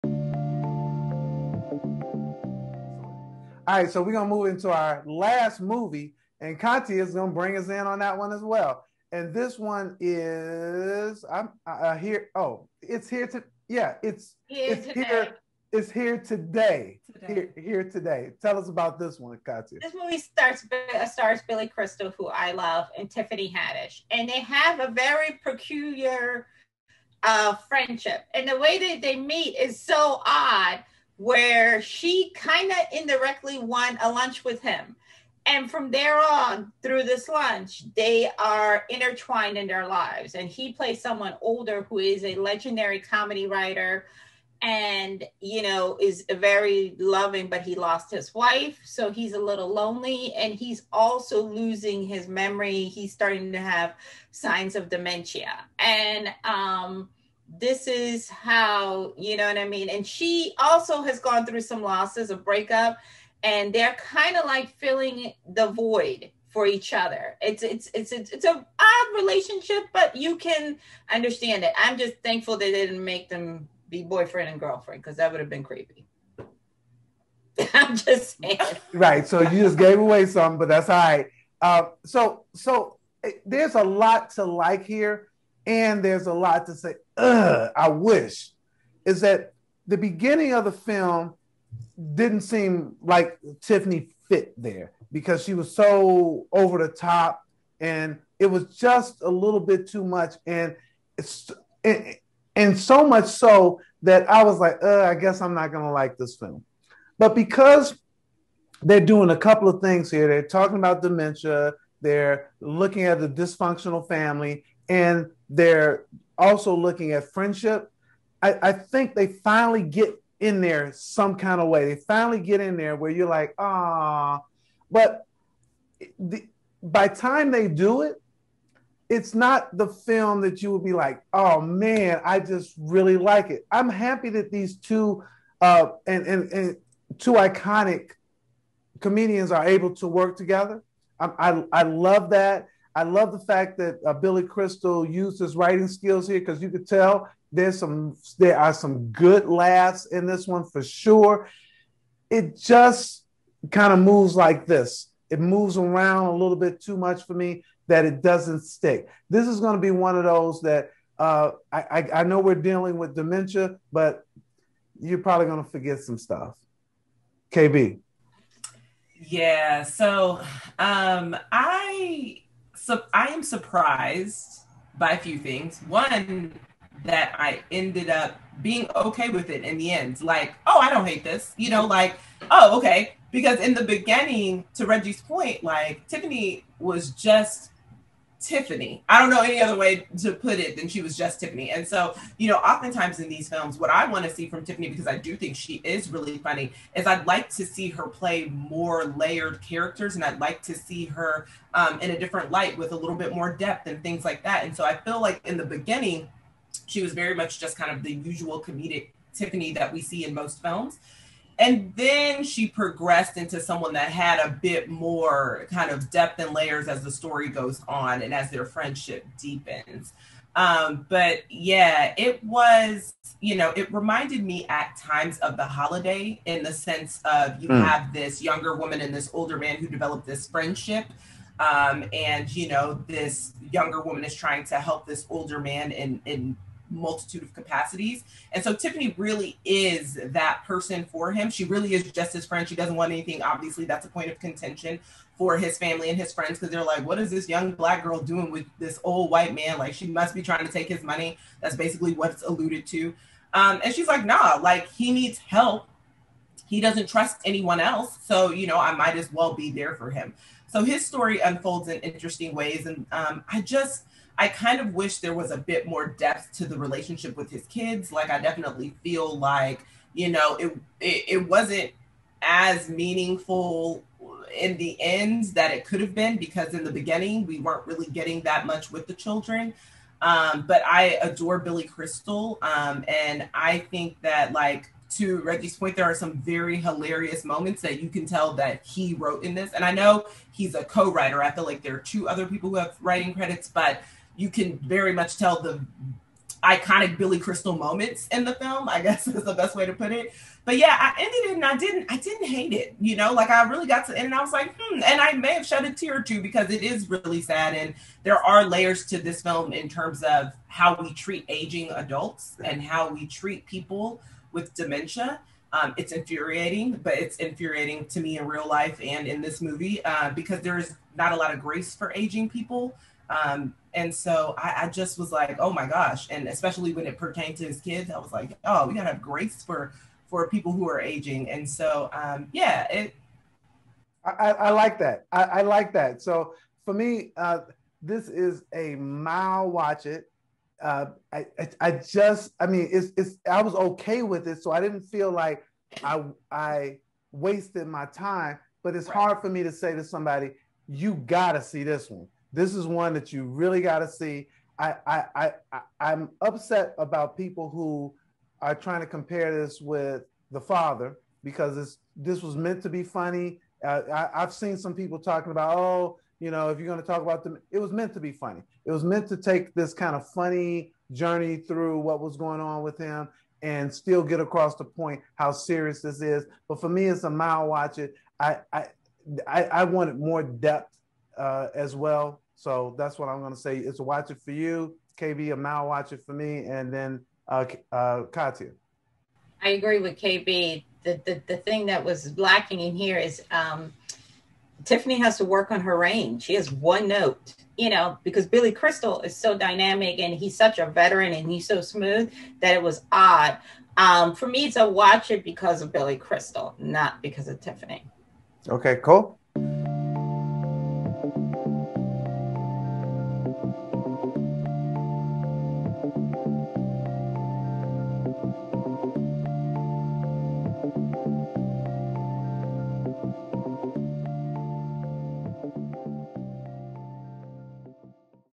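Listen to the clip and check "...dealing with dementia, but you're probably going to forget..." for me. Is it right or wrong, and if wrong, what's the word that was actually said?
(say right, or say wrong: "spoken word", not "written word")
right.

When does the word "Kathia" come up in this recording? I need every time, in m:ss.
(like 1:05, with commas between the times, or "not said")
0:19, 6:28.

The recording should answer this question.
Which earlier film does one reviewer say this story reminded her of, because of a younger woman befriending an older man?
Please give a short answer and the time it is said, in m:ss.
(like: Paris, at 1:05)
The Holiday, at 3:45.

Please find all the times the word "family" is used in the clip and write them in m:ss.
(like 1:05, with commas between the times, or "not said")
1:54, 4:05.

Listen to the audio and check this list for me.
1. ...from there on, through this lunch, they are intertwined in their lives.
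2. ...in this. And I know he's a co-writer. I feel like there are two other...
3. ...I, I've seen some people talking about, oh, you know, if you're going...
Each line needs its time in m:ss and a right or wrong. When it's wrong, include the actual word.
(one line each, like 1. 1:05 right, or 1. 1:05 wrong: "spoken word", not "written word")
1. 0:35 right
2. 4:49 right
3. 6:04 right.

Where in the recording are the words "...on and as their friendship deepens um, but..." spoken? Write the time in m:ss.
3:37.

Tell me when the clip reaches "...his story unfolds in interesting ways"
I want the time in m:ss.
4:20.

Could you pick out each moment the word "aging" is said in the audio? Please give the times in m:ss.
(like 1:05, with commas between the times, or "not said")
5:11, 5:22, 5:31.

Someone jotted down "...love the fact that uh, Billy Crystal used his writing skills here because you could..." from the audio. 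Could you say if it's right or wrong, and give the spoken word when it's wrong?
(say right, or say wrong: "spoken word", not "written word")
right.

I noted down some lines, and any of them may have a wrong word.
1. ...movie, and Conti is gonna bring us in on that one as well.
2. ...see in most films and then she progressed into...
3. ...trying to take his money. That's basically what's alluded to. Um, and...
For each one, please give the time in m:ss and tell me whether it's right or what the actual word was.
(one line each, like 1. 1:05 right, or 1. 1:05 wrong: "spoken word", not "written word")
1. 0:05 right
2. 3:30 right
3. 4:10 right.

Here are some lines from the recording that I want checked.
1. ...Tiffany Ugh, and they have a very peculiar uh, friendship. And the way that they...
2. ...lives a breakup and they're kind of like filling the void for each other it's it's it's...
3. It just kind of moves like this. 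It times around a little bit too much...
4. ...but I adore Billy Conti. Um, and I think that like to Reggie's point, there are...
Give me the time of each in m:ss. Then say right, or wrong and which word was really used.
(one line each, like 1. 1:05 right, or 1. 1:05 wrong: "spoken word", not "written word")
1. 0:23 wrong: "Haddish", not "Ugh"
2. 1:01 wrong: "losses", not "lives"
3. 2:32 wrong: "moves", not "times"
4. 4:40 wrong: "Crystal", not "Conti".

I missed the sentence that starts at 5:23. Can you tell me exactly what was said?
Um, and so I, I, just was like, oh my gosh.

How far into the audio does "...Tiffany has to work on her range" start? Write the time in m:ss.
6:34.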